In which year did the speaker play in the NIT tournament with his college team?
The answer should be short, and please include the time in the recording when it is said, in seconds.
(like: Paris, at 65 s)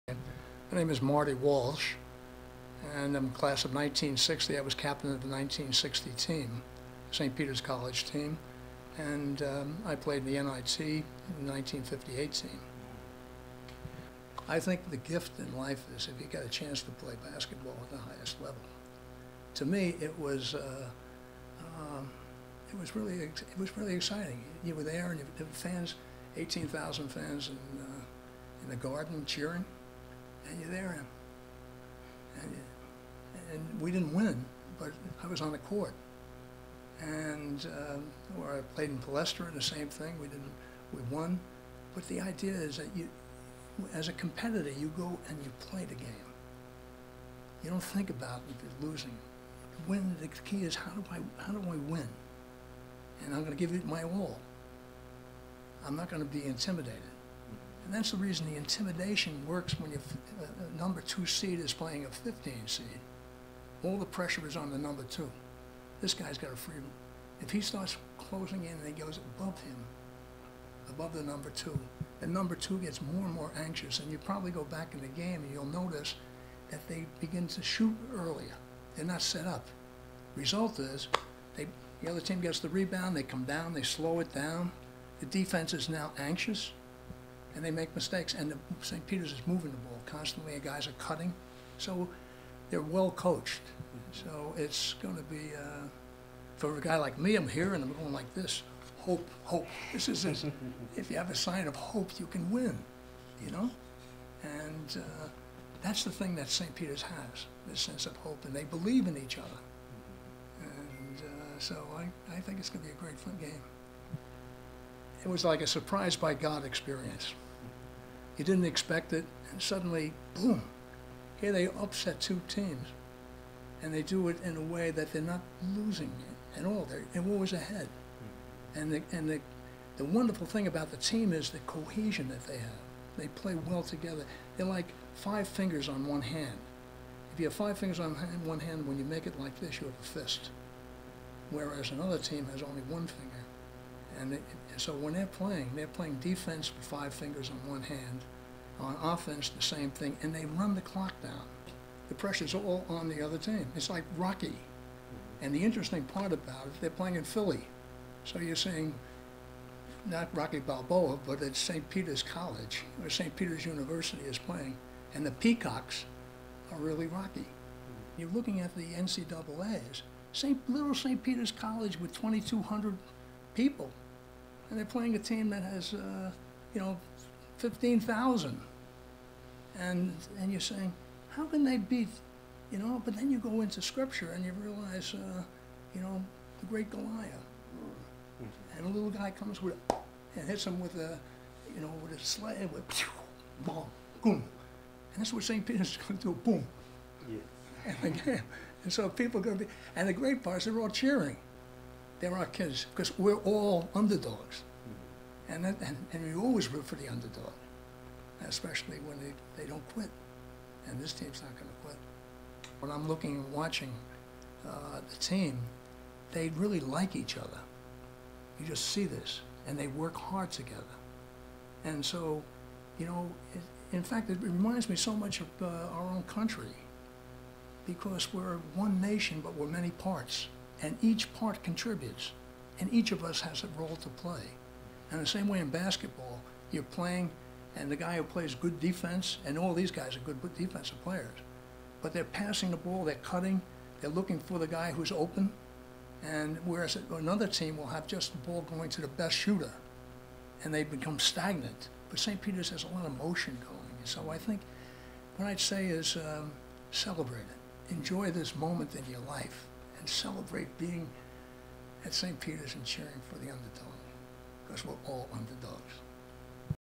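1958, at 11 s.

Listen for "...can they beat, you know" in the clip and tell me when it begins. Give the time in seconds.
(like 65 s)
181 s.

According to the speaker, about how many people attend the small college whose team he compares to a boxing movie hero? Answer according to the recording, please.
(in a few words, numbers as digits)
2,200.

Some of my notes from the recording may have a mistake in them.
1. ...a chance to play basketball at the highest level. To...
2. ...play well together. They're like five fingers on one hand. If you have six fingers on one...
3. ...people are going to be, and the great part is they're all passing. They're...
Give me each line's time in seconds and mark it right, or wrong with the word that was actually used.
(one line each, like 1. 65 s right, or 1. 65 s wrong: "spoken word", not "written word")
1. 16 s right
2. 133 s wrong: "five", not "six"
3. 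199 s wrong: "cheering", not "passing".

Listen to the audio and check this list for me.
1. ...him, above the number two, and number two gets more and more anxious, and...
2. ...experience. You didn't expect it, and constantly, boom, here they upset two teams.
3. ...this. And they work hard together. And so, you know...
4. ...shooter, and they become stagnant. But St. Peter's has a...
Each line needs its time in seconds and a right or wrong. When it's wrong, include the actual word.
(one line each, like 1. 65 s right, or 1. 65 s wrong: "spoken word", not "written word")
1. 69 s right
2. 116 s wrong: "suddenly", not "constantly"
3. 219 s right
4. 249 s right.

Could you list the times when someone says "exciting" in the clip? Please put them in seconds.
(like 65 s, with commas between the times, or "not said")
23 s.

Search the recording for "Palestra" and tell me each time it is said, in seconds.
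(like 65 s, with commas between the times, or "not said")
38 s.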